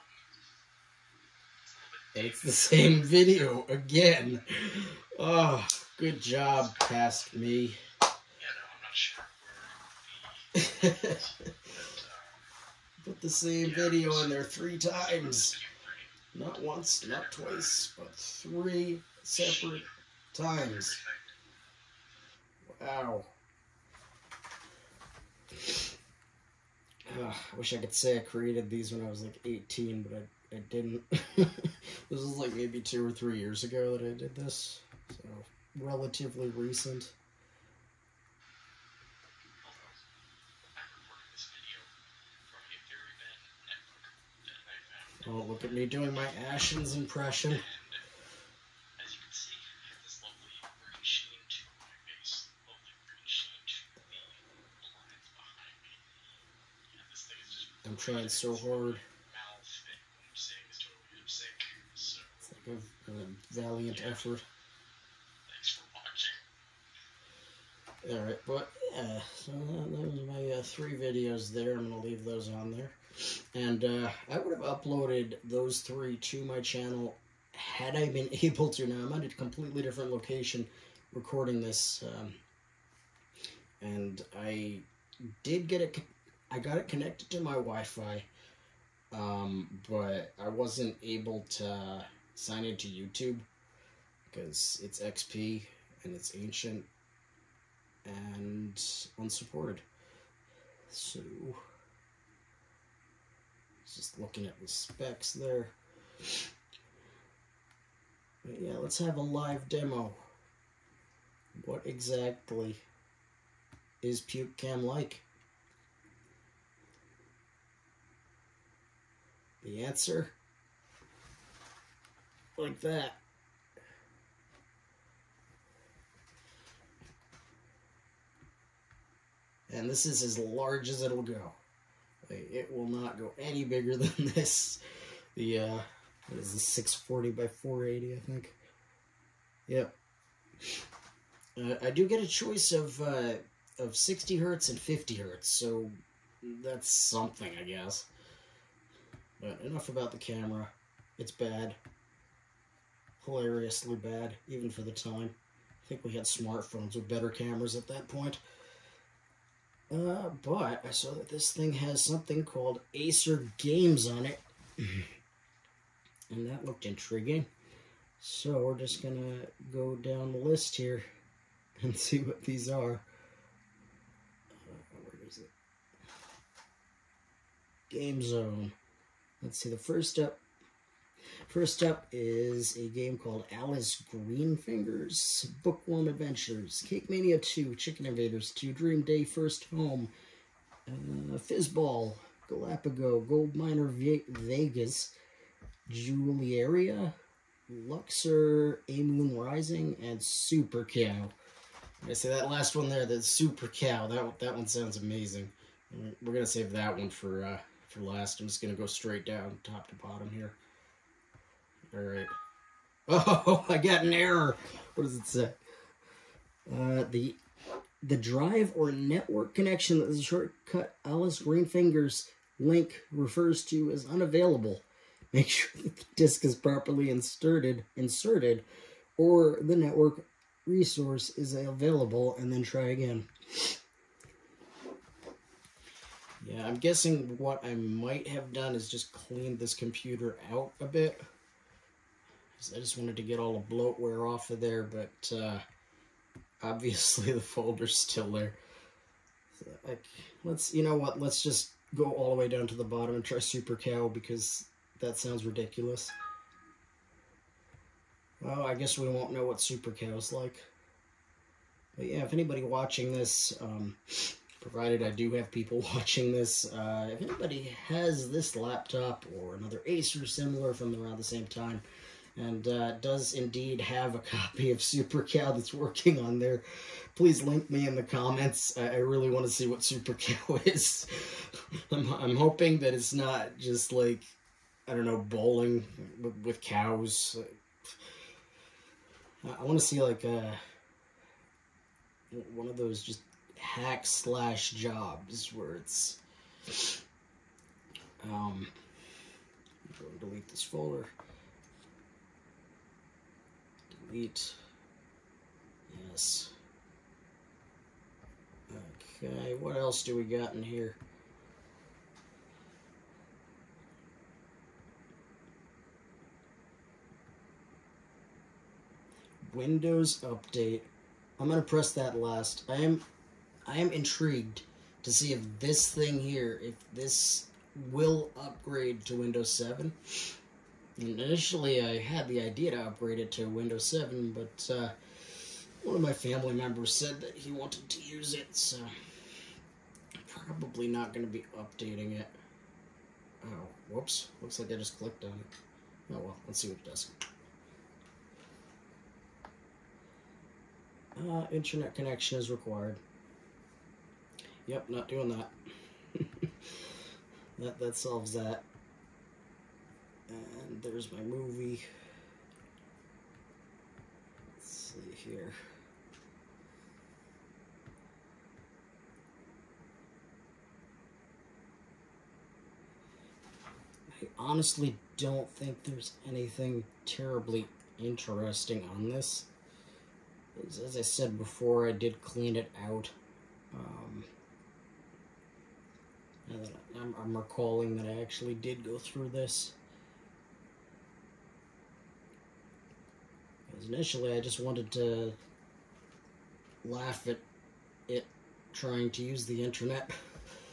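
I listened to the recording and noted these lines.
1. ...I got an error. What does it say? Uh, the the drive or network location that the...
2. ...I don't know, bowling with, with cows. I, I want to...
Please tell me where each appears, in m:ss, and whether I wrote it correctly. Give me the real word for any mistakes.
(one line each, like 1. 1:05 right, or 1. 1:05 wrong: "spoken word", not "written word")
1. 3:33 wrong: "connection", not "location"
2. 4:44 right.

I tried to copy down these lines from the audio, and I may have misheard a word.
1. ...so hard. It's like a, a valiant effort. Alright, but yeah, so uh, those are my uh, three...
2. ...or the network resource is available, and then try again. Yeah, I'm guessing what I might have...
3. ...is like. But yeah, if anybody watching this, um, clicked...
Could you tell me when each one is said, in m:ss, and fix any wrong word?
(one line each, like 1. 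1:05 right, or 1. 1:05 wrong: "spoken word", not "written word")
1. 0:58 right
2. 3:49 right
3. 4:20 wrong: "provided", not "clicked".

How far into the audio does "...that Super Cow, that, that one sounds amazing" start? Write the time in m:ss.
3:23.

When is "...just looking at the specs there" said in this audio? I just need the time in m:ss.
1:43.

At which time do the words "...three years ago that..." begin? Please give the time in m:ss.
0:33.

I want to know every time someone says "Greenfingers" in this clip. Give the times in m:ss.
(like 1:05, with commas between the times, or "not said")
3:04, 3:41.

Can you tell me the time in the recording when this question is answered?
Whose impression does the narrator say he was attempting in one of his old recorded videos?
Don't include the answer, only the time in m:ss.
0:46.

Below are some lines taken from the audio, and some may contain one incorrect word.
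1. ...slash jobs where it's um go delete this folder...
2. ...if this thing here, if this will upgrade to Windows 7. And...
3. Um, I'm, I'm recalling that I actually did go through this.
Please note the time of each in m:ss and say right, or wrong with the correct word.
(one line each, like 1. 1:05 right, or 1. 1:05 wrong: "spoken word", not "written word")
1. 4:54 right
2. 5:25 right
3. 6:23 right.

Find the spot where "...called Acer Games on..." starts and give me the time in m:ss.
2:42.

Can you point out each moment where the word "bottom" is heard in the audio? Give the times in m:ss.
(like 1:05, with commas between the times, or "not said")
3:29, 4:12.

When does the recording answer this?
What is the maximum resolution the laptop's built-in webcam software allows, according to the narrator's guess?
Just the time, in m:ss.
2:16.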